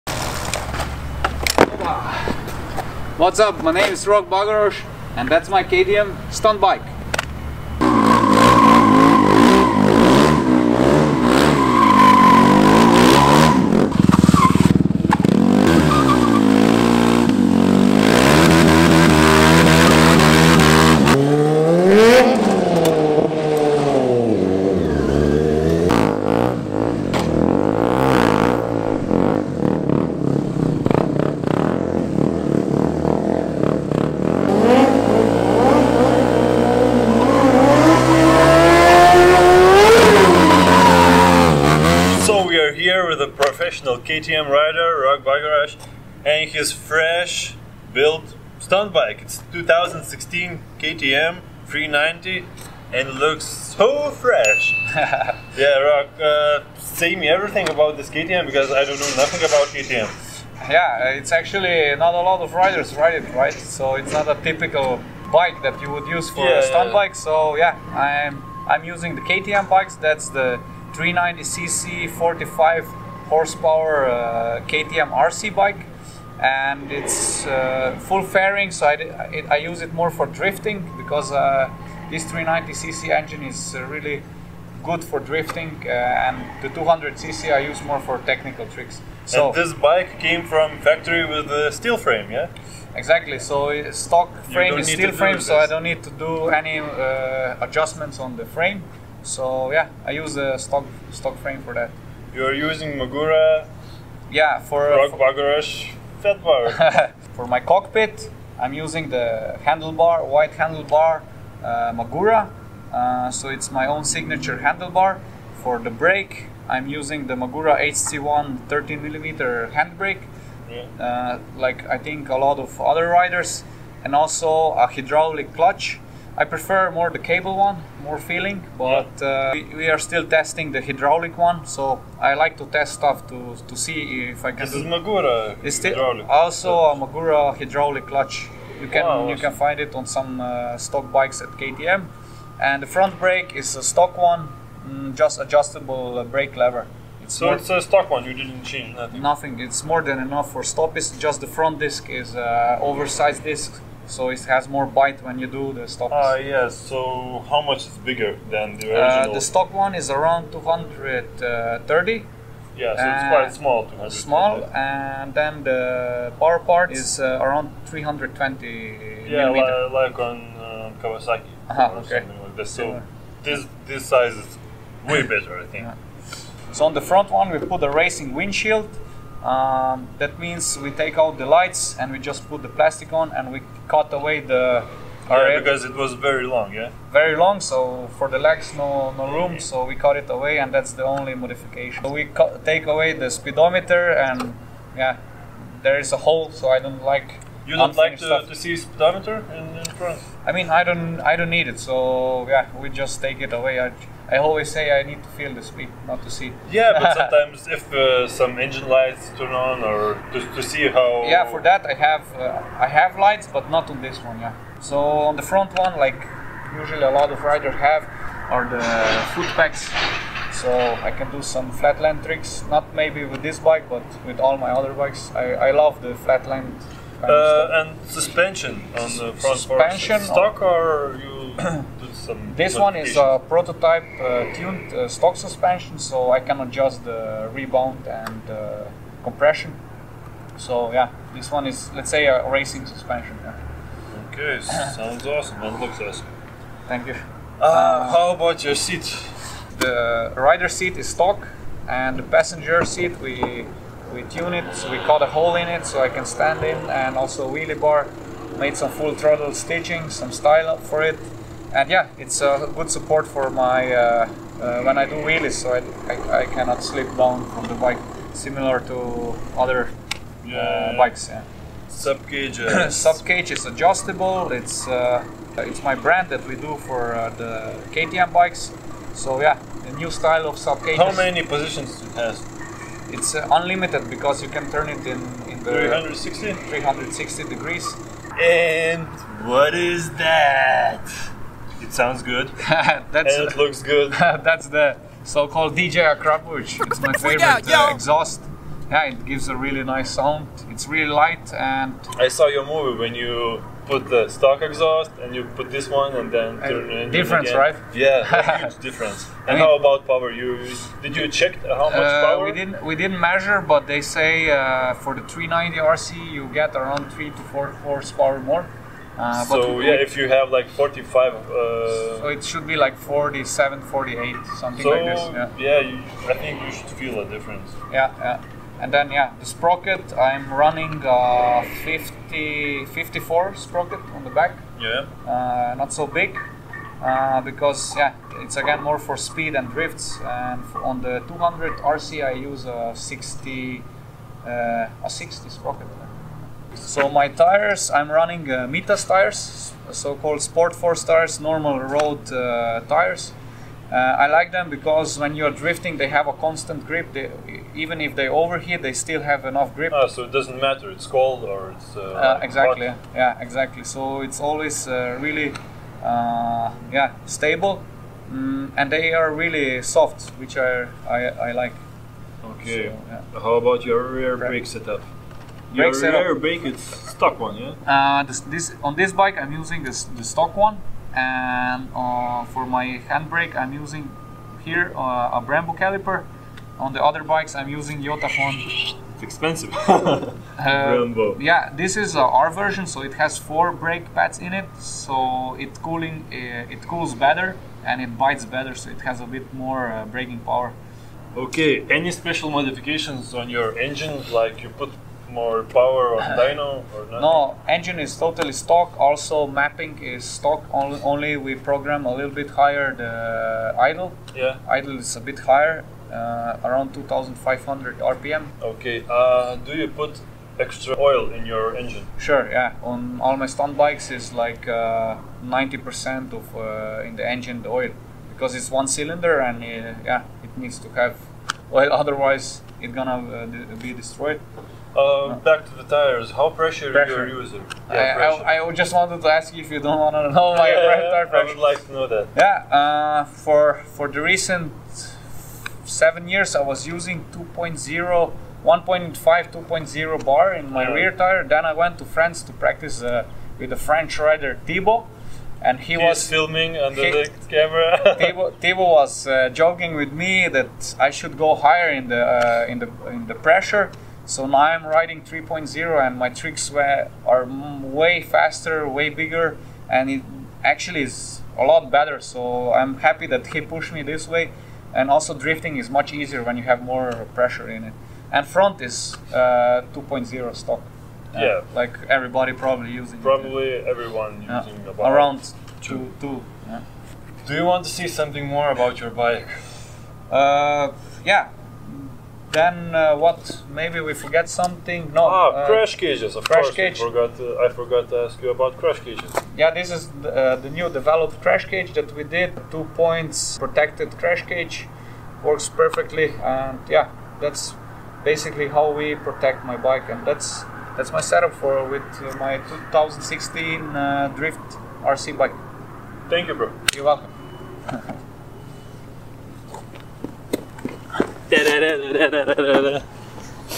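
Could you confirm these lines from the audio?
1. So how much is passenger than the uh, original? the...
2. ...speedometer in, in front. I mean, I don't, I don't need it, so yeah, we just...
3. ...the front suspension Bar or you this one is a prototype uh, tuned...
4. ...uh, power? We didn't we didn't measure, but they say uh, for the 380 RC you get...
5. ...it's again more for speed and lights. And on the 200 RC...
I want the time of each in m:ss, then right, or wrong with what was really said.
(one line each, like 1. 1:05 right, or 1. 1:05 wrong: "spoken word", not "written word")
1. 2:36 wrong: "bigger", not "passenger"
2. 3:18 right
3. 3:49 wrong: "Stock", not "Bar"
4. 5:12 wrong: "390", not "380"
5. 5:38 wrong: "drifts", not "lights".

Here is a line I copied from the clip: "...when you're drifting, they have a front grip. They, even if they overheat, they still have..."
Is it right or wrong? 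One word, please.
wrong.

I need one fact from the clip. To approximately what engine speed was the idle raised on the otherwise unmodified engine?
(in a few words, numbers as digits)
2,500 RPM.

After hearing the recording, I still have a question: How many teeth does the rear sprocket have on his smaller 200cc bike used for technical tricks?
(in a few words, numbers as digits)
60.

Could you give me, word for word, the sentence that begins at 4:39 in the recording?
So yeah, a new style of sub cage.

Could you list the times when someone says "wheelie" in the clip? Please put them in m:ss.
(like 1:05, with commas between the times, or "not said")
4:17, 4:25.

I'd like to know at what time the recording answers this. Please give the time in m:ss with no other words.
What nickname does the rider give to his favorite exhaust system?
4:55.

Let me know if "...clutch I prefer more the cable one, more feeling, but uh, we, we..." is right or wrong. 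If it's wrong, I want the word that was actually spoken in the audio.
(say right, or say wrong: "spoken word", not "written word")
right.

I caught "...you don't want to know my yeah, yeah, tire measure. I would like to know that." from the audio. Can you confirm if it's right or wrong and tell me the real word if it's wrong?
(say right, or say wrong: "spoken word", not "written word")
wrong: "pressure", not "measure".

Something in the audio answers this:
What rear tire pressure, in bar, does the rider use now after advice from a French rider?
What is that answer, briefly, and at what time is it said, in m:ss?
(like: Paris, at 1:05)
3.0 bar, at 7:45.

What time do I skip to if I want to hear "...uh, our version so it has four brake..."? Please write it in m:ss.
6:32.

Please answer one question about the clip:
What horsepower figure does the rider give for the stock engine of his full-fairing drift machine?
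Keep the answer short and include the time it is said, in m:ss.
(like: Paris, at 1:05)
45, at 1:12.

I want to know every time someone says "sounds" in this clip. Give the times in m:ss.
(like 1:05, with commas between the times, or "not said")
4:04, 4:51, 5:00.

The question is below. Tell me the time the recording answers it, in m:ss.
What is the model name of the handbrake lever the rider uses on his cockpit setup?
1:57.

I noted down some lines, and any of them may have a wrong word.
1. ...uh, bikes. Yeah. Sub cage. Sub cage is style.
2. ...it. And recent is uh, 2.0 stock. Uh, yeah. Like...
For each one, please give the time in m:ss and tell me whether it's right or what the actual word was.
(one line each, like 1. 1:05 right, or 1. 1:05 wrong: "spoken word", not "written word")
1. 4:30 wrong: "adjustable", not "style"
2. 7:57 wrong: "front", not "recent".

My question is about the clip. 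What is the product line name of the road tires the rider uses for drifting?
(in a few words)
Sport Force.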